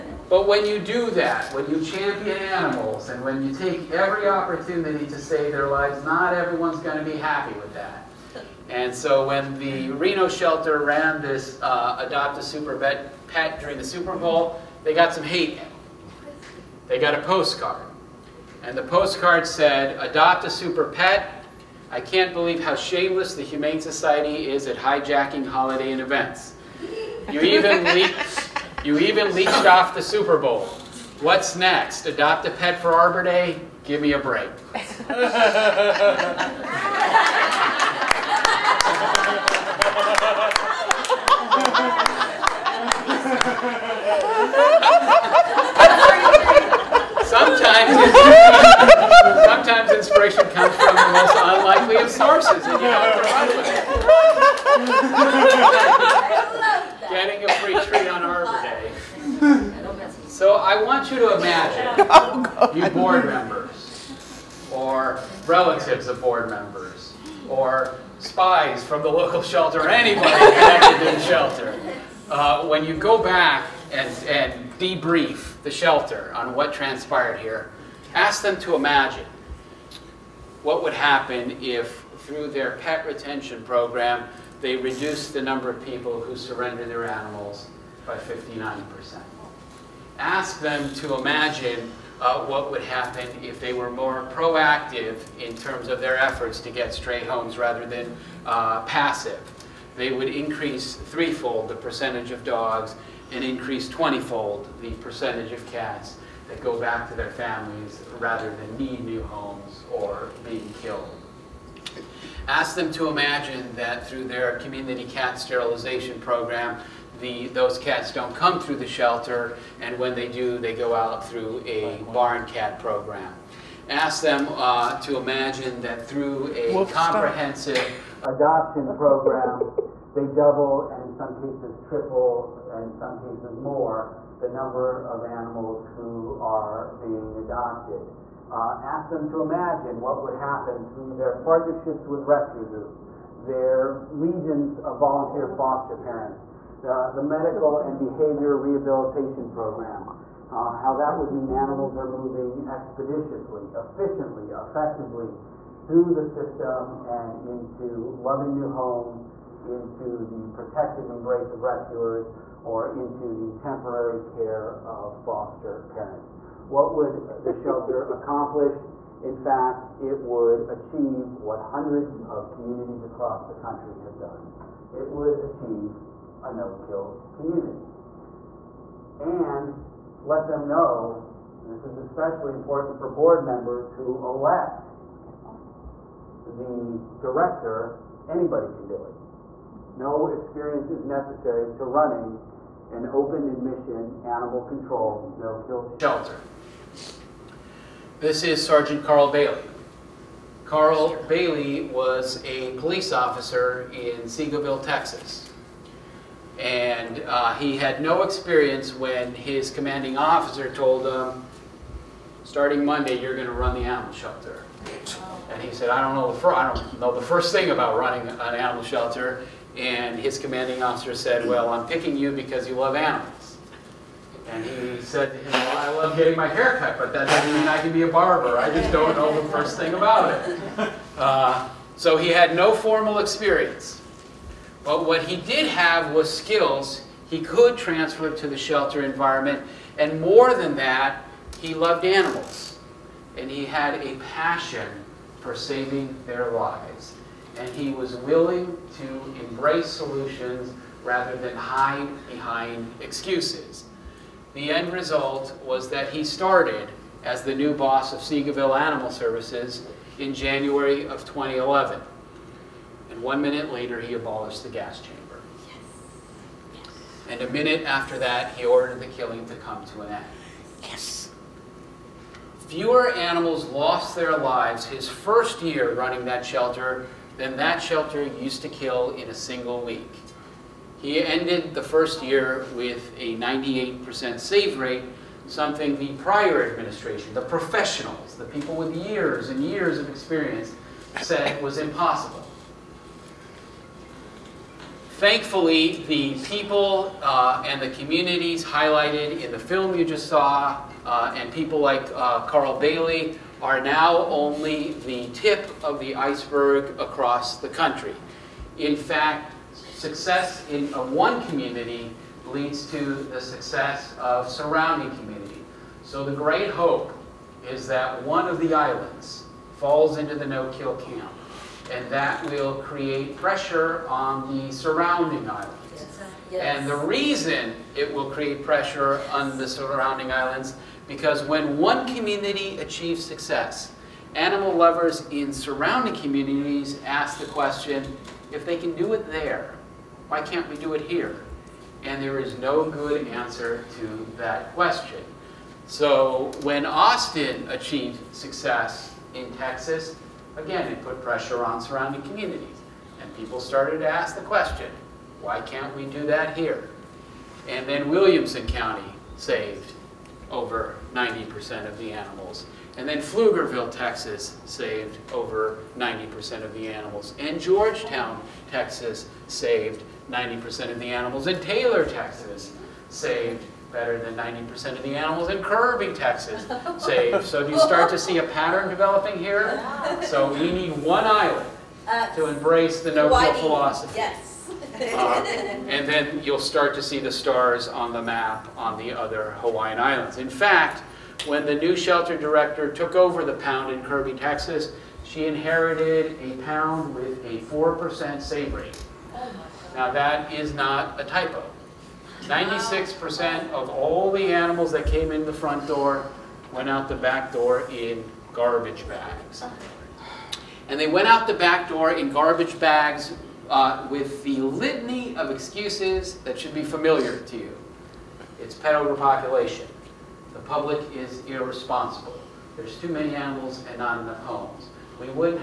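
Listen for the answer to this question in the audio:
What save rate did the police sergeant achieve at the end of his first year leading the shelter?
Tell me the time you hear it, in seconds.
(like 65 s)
283 s.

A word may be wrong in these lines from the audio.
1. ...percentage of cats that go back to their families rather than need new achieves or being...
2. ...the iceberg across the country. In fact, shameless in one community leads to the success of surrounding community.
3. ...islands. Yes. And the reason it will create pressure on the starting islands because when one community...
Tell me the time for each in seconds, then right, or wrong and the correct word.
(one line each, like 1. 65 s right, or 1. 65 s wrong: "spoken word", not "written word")
1. 104 s wrong: "homes", not "achieves"
2. 305 s wrong: "success", not "shameless"
3. 325 s wrong: "surrounding", not "starting".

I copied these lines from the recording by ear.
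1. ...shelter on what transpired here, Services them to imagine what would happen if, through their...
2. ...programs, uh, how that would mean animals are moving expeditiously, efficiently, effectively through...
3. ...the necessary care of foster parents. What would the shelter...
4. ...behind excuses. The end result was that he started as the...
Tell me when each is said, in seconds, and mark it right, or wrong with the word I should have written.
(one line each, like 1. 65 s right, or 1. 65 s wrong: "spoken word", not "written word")
1. 75 s wrong: "Ask", not "Services"
2. 149 s right
3. 163 s wrong: "temporary", not "necessary"
4. 252 s right.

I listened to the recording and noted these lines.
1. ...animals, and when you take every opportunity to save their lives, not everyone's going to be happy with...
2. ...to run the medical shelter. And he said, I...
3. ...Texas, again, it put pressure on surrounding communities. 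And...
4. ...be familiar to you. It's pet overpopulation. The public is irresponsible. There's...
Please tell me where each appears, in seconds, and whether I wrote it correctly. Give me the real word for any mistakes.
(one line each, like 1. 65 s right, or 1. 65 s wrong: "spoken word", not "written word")
1. 2 s right
2. 213 s wrong: "animal", not "medical"
3. 349 s right
4. 416 s right.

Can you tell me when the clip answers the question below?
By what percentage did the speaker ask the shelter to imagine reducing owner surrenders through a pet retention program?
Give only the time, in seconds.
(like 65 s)
88 s.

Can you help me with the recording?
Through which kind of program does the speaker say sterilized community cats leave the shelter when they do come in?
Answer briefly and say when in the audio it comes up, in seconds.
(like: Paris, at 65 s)
barn cat program, at 122 s.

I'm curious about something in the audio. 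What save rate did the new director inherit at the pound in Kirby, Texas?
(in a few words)
4%.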